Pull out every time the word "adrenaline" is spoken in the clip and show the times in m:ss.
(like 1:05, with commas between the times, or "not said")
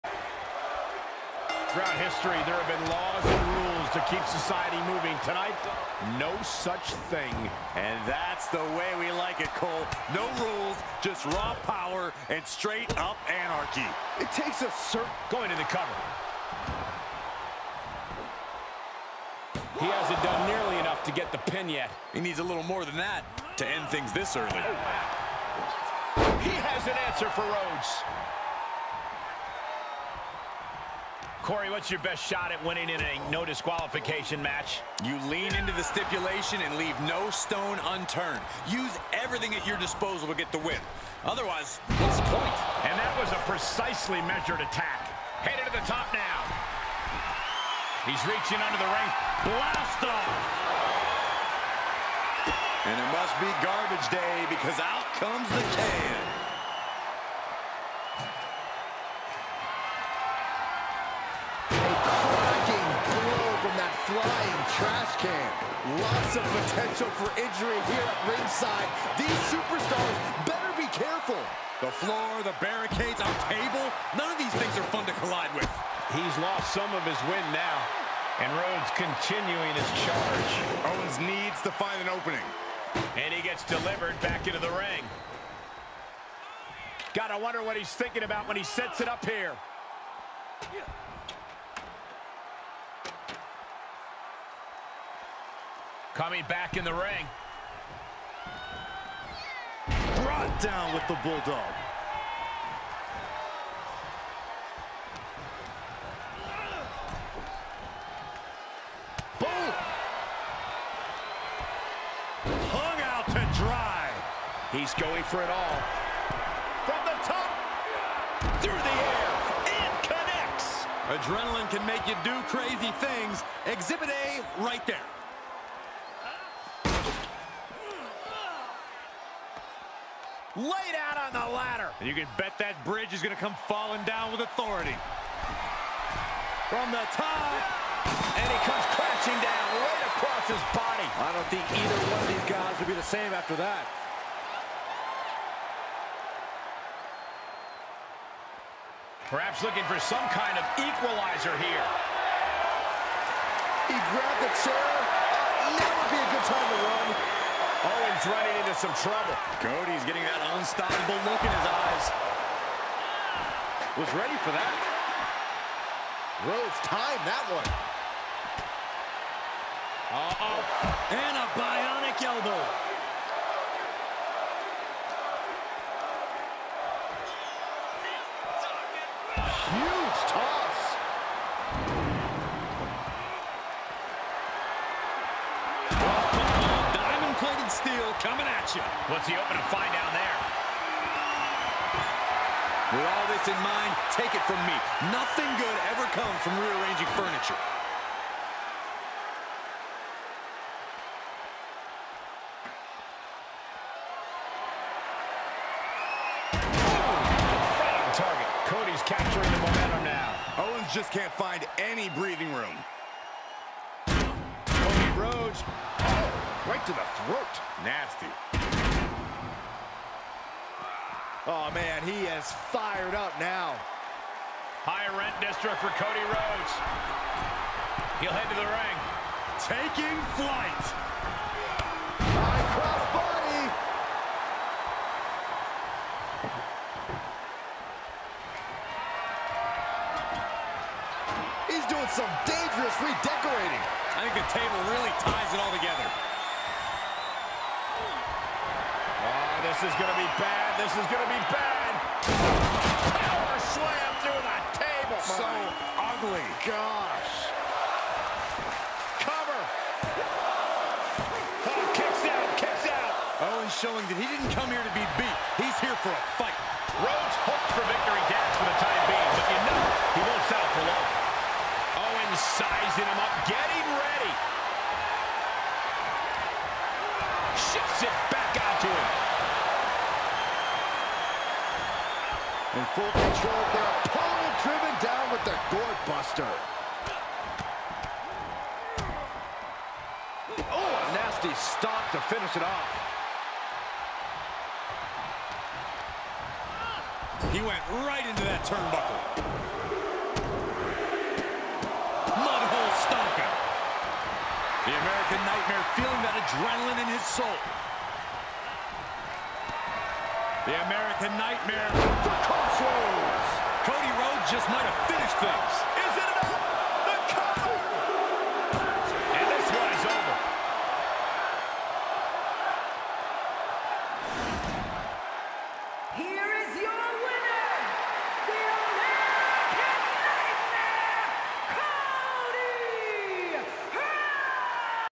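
2:01, 5:06.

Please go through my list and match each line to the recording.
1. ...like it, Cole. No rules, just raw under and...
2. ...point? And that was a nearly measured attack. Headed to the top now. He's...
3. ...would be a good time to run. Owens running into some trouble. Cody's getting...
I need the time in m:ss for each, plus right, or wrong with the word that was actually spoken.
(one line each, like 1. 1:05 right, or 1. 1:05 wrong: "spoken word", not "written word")
1. 0:09 wrong: "power", not "under"
2. 0:42 wrong: "precisely", not "nearly"
3. 2:35 right.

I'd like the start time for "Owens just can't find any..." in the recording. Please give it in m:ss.
3:30.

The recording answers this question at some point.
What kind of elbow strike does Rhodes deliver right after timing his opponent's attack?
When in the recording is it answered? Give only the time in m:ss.
2:51.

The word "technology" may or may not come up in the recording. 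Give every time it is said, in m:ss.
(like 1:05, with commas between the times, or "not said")
not said.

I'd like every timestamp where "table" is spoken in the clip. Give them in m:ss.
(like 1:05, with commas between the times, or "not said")
1:13, 4:04, 4:14.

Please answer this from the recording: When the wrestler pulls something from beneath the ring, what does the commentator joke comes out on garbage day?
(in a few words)
The can.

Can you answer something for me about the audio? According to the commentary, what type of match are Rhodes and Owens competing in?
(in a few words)
No disqualification.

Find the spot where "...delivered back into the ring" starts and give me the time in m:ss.
1:23.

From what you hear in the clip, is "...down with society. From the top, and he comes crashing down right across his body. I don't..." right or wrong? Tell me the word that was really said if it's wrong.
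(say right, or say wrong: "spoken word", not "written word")
wrong: "authority", not "society".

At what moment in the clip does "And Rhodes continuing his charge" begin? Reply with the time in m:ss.
1:18.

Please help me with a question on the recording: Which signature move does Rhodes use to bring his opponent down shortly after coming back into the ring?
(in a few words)
Bulldog.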